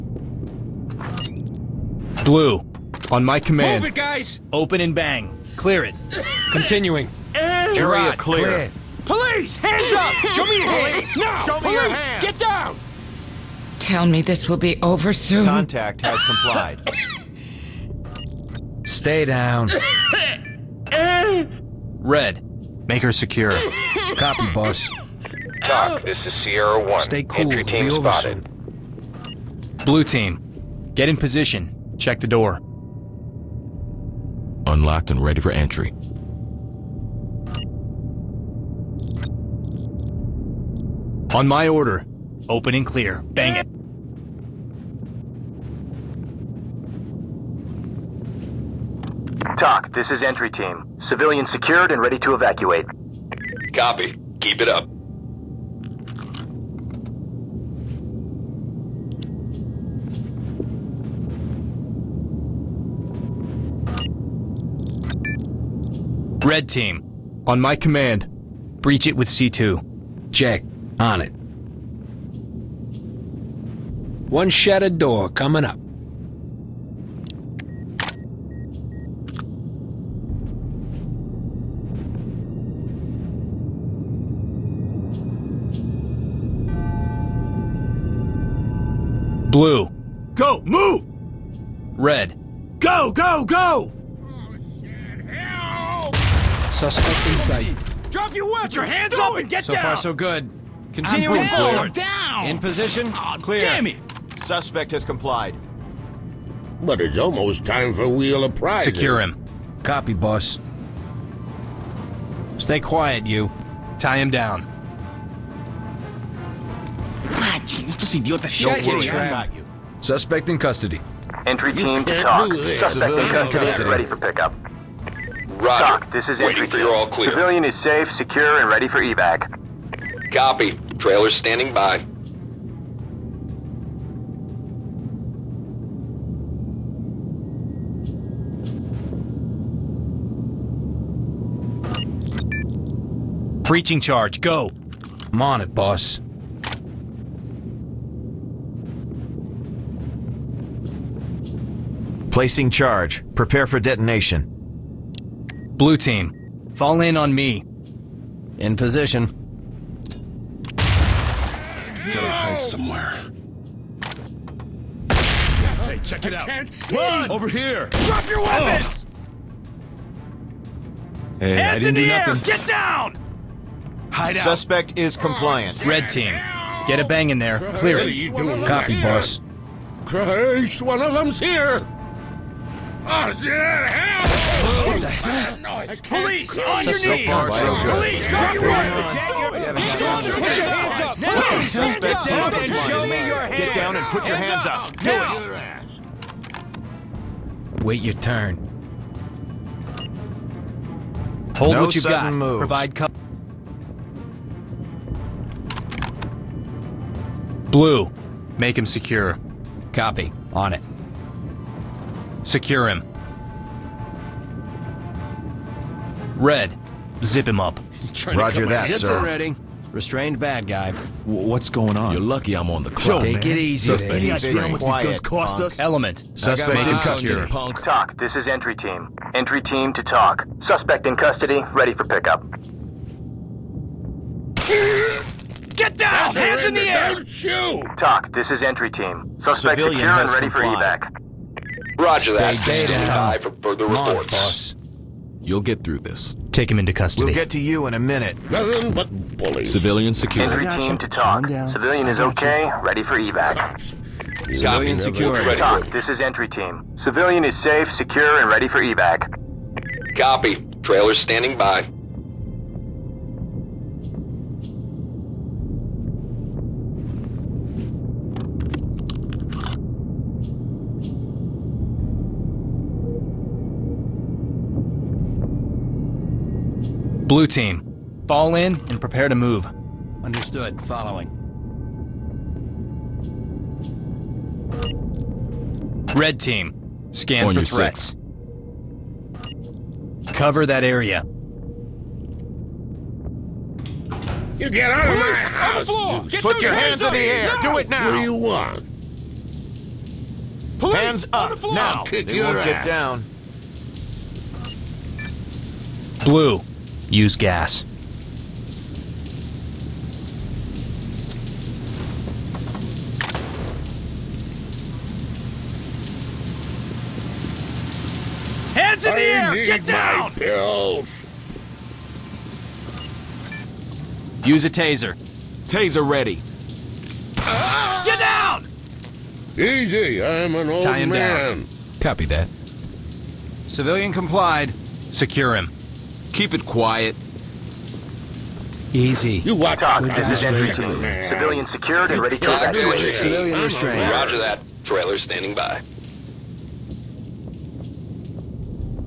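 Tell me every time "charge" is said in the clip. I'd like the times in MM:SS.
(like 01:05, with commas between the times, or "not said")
02:24, 02:32.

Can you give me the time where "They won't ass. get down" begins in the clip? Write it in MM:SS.
05:02.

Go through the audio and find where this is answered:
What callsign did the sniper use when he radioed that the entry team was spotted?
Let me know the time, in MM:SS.
00:26.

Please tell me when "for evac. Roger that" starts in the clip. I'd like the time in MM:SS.
04:01.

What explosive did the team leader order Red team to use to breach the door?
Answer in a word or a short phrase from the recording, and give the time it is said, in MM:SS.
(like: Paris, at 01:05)
C2, at 01:09.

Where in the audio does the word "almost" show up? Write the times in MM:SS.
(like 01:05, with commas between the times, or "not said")
01:47.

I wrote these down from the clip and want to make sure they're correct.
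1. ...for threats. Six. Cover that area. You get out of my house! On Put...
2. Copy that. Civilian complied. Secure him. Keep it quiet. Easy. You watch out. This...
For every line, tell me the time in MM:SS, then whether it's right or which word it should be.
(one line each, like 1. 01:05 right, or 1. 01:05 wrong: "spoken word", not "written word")
1. 04:47 right
2. 05:32 right.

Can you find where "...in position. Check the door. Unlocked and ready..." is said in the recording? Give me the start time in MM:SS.
00:31.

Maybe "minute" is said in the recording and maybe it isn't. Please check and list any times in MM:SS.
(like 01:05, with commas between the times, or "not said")
04:07.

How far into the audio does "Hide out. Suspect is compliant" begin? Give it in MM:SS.
02:54.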